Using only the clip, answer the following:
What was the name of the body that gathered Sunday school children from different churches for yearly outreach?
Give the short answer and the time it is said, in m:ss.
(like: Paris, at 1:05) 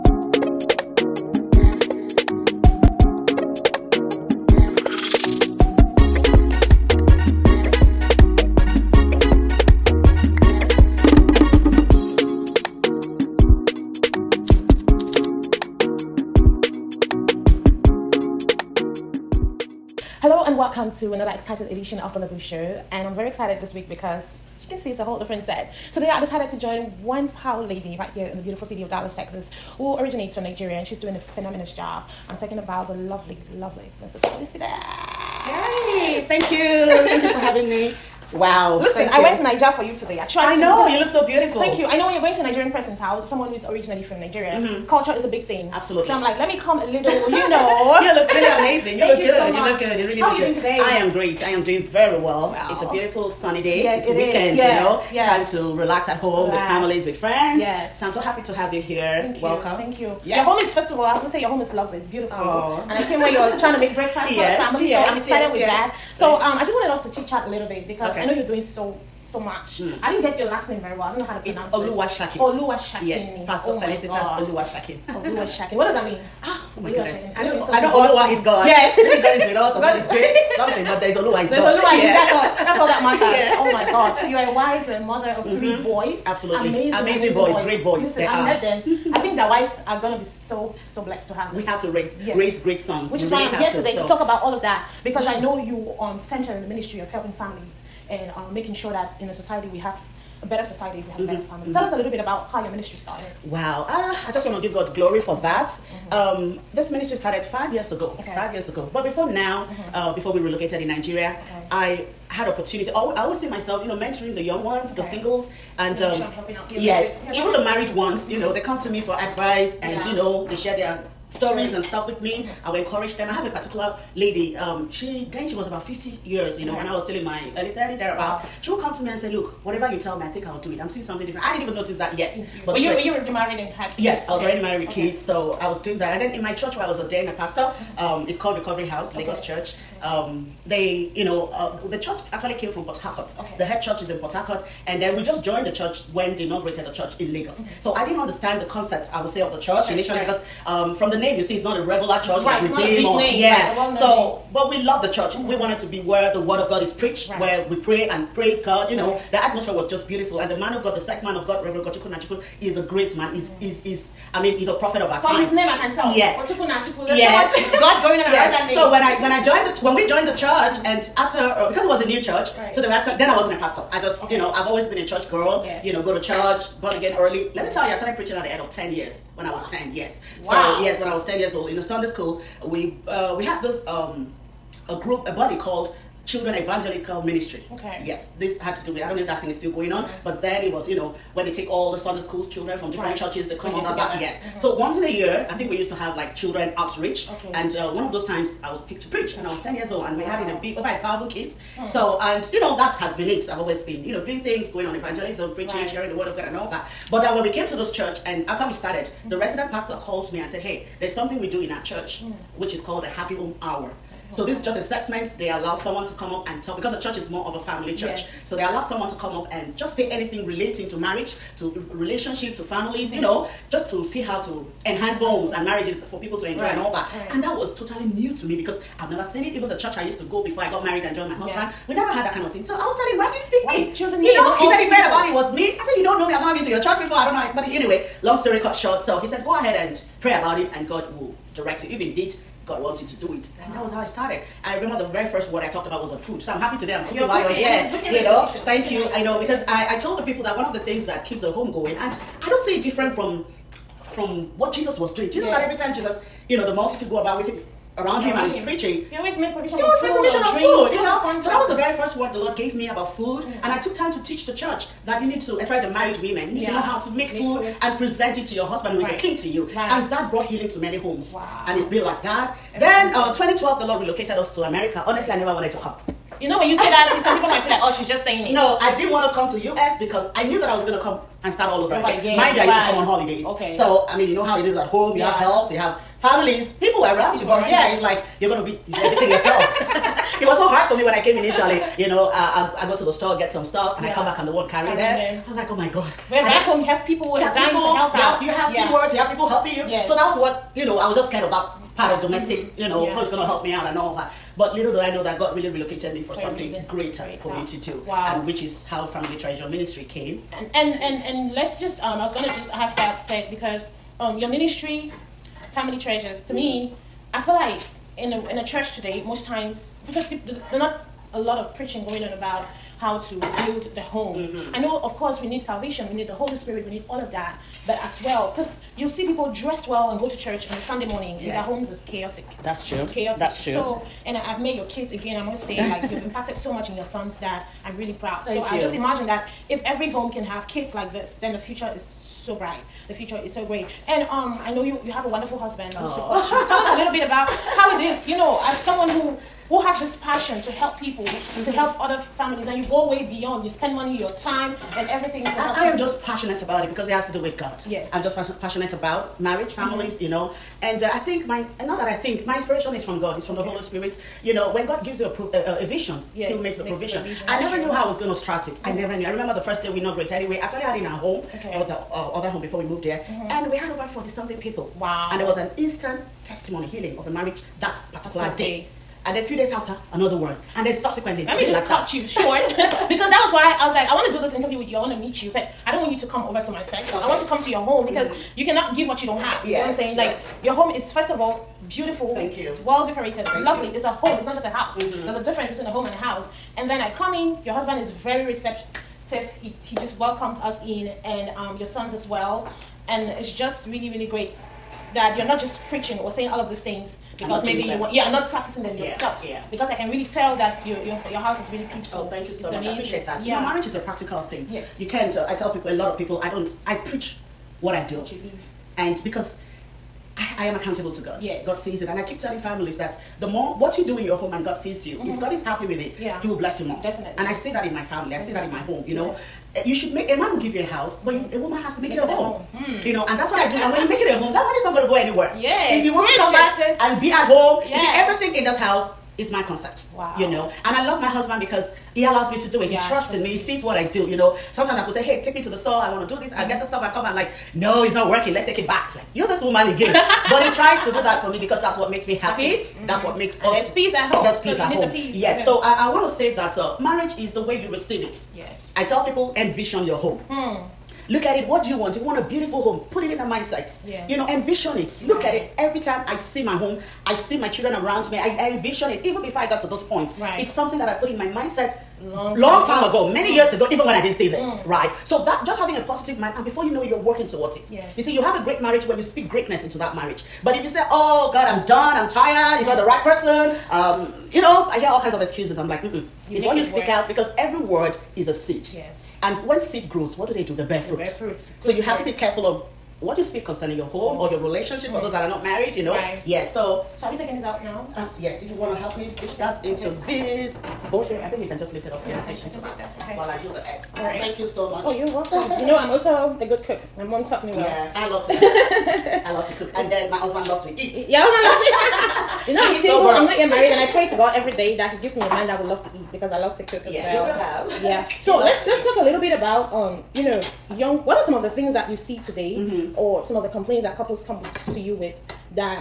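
Children Evangelical Ministry, at 3:06.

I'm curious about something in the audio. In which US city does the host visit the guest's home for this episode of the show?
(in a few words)
Dallas, Texas.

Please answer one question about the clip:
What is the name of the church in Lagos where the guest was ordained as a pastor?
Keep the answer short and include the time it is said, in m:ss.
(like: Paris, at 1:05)
Recovery House, at 2:18.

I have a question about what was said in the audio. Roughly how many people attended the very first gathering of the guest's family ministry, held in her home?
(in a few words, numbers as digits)
over 40.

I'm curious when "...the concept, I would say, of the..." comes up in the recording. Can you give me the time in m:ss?
2:28.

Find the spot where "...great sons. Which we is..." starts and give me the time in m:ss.
1:32.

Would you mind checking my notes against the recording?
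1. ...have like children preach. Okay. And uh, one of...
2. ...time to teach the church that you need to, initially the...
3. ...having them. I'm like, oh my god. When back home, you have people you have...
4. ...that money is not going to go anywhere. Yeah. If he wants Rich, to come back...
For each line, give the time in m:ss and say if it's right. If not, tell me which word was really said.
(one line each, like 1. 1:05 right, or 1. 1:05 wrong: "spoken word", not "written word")
1. 3:15 wrong: "outreach", not "preach"
2. 4:23 wrong: "especially", not "initially"
3. 4:54 wrong: "carrying", not "having"
4. 7:14 right.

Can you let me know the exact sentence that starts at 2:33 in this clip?
Right, so but we love the church.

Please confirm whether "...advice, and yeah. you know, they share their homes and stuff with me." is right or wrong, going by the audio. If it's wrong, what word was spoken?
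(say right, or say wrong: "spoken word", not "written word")
wrong: "stories", not "homes".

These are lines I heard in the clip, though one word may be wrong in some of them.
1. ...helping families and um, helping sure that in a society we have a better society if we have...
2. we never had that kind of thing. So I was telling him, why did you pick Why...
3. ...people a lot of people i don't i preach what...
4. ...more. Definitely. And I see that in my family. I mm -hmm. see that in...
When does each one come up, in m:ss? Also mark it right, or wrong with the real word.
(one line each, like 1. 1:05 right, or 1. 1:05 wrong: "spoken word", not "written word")
1. 1:37 wrong: "making", not "helping"
2. 3:51 right
3. 6:55 right
4. 7:06 right.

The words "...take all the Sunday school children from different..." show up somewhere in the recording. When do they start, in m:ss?
3:11.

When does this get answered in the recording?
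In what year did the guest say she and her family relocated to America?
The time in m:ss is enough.
4:33.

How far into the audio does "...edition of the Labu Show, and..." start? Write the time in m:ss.
0:21.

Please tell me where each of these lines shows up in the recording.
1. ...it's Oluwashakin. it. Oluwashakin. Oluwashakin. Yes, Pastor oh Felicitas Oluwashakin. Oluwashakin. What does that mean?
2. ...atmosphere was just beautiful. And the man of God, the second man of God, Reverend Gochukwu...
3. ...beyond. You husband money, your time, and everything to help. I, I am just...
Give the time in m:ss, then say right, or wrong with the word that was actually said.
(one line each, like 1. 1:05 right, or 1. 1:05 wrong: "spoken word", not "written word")
1. 1:11 right
2. 2:39 right
3. 5:53 wrong: "spend", not "husband".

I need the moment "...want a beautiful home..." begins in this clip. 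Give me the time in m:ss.
7:42.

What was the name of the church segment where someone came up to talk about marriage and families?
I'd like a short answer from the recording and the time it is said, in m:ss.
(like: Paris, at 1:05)
happy home hour, at 3:33.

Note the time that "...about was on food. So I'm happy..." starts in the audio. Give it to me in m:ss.
4:05.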